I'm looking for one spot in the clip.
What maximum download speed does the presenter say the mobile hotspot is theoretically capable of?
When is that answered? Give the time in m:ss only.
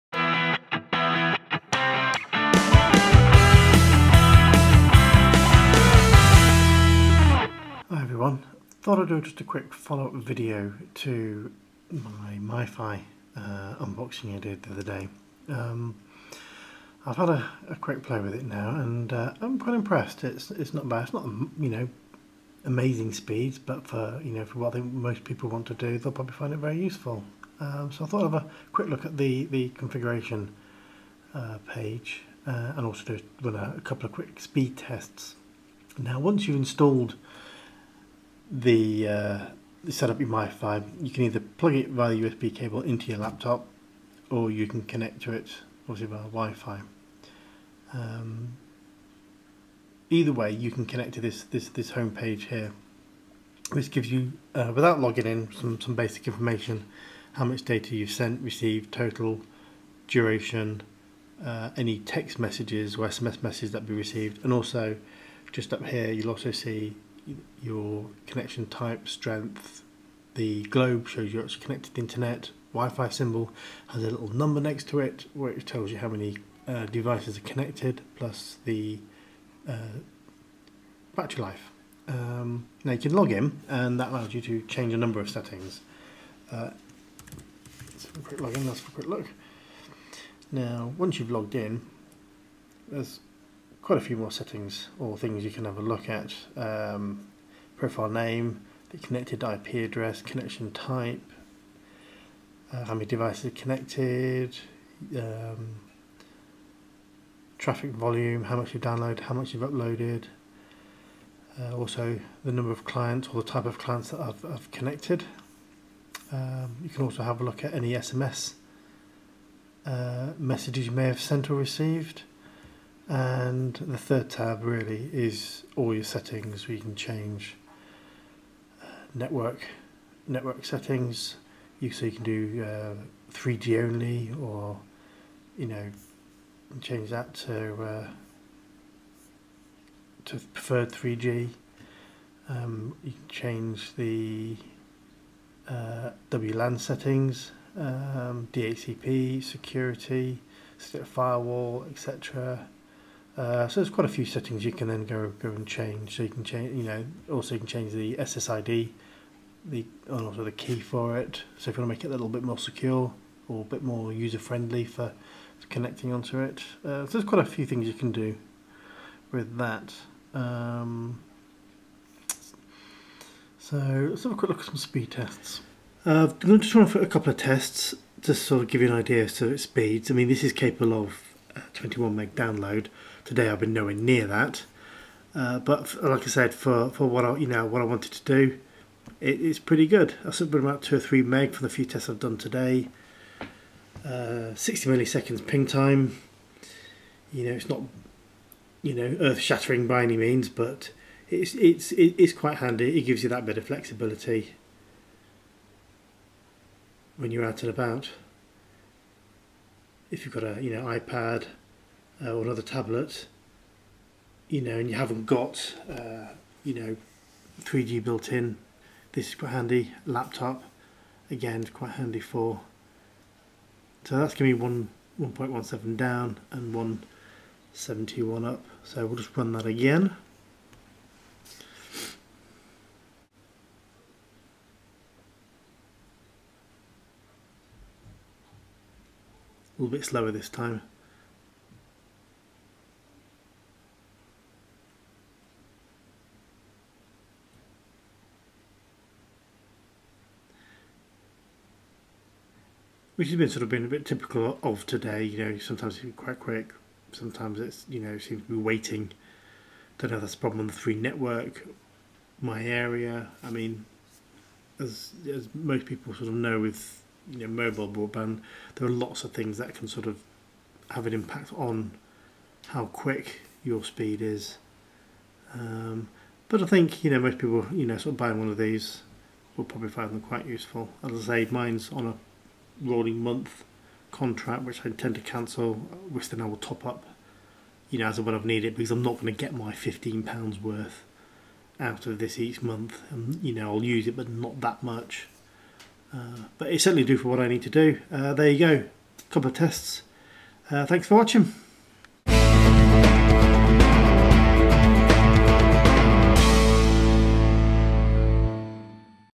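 3:01.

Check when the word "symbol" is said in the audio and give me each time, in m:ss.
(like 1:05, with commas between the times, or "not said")
1:13.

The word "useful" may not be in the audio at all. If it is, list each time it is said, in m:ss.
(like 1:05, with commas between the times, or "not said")
0:26, 4:40.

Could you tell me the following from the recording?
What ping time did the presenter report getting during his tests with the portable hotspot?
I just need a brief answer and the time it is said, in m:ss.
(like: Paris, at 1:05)
60 milliseconds, at 3:14.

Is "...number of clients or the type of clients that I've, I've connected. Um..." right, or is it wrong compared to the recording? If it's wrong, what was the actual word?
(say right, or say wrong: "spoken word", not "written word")
right.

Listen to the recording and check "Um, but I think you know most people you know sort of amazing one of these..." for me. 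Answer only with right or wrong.
wrong.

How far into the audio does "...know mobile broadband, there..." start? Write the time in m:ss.
4:27.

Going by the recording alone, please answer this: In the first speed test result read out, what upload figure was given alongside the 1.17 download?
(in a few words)
171.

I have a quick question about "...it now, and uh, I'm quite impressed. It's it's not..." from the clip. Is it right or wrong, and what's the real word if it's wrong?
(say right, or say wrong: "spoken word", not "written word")
right.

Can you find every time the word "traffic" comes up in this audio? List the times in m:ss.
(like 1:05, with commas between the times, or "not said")
1:47.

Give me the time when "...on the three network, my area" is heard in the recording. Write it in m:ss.
4:20.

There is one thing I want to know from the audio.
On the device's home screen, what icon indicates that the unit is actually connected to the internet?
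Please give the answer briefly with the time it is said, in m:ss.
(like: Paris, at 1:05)
The globe, at 1:10.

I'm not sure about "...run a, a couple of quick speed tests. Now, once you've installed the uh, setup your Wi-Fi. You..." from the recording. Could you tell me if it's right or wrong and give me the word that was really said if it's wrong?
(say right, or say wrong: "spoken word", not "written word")
right.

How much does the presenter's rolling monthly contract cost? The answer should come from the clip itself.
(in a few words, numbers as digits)
£15.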